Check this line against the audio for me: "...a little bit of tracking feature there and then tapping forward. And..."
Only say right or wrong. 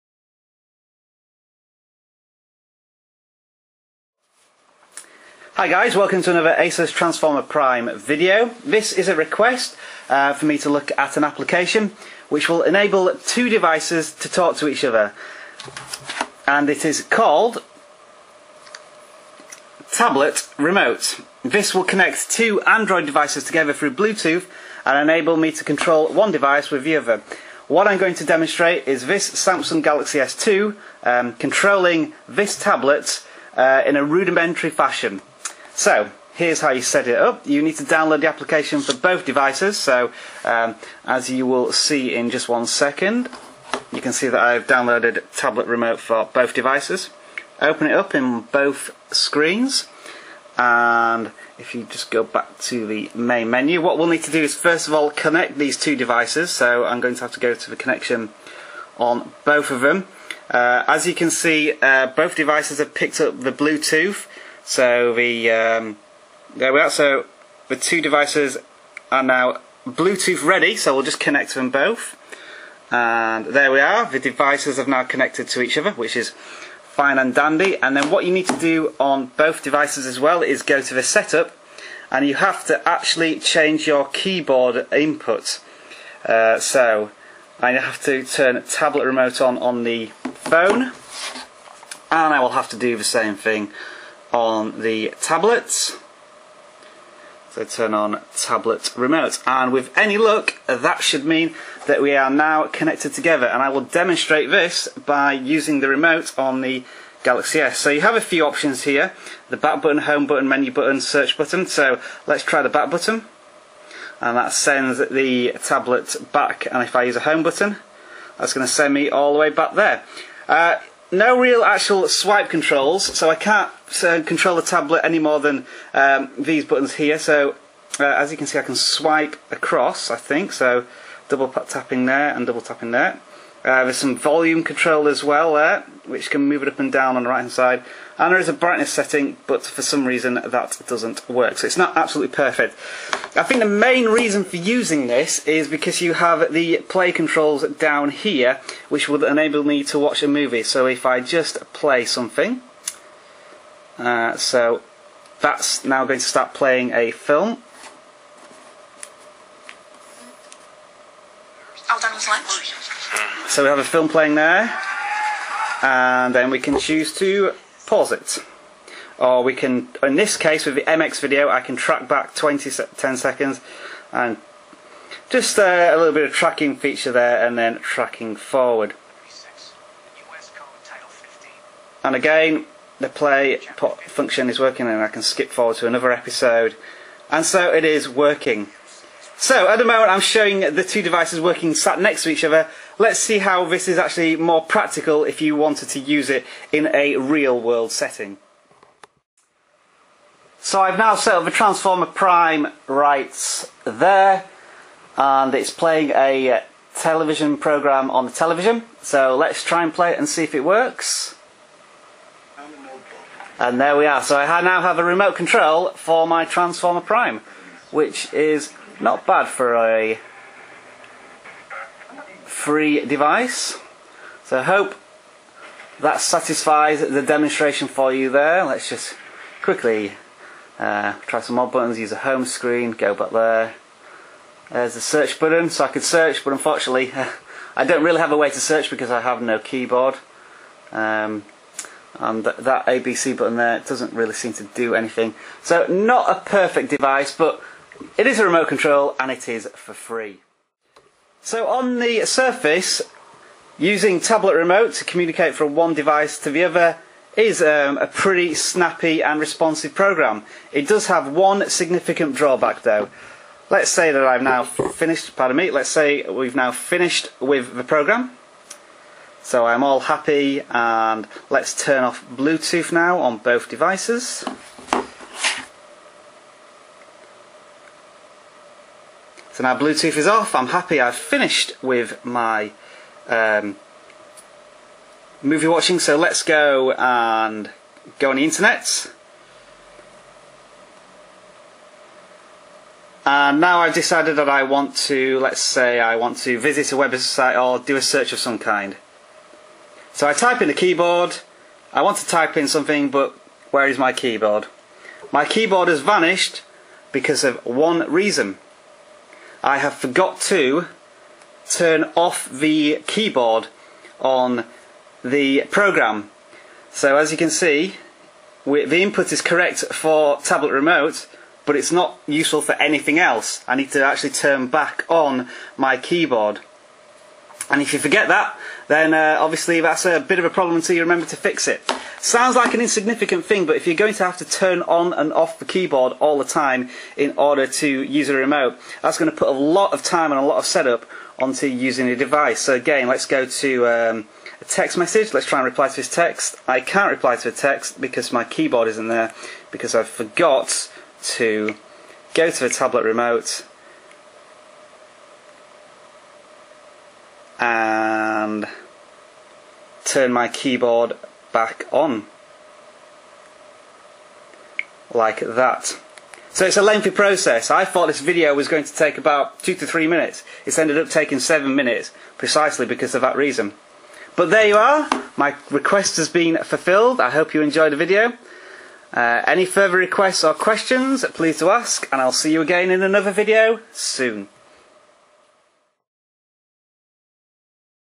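wrong.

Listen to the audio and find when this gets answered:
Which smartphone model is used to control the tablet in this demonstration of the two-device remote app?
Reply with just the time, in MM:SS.
00:29.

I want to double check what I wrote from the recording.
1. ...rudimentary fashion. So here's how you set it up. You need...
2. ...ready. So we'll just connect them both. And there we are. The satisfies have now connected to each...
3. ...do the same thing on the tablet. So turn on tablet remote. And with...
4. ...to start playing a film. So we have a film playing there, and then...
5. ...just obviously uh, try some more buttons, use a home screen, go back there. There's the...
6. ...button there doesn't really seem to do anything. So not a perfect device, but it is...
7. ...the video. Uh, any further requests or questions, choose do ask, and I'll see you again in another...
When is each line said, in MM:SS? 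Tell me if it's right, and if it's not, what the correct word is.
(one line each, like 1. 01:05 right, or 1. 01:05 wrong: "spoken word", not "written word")
1. 00:34 right
2. 01:10 wrong: "devices", not "satisfies"
3. 01:32 right
4. 02:36 right
5. 03:48 wrong: "quickly", not "obviously"
6. 04:03 right
7. 06:17 wrong: "please", not "choose".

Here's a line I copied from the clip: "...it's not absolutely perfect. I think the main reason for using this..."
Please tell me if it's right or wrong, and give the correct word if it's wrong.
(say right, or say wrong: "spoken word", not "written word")
right.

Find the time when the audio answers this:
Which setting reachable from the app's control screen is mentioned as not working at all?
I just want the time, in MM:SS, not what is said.
02:18.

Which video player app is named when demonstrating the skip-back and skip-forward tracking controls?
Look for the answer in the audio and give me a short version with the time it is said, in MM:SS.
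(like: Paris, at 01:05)
MX video, at 02:50.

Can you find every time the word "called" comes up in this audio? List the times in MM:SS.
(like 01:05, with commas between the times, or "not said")
00:17.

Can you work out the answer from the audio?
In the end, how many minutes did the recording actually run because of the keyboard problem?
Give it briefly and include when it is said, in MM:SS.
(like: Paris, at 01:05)
7 minutes, at 06:11.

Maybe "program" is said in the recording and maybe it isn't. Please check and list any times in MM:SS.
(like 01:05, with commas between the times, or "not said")
03:27, 04:19, 04:27, 05:15.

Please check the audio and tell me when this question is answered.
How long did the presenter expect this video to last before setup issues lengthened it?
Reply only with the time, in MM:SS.
06:09.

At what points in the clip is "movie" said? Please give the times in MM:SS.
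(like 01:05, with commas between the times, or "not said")
02:30, 04:45.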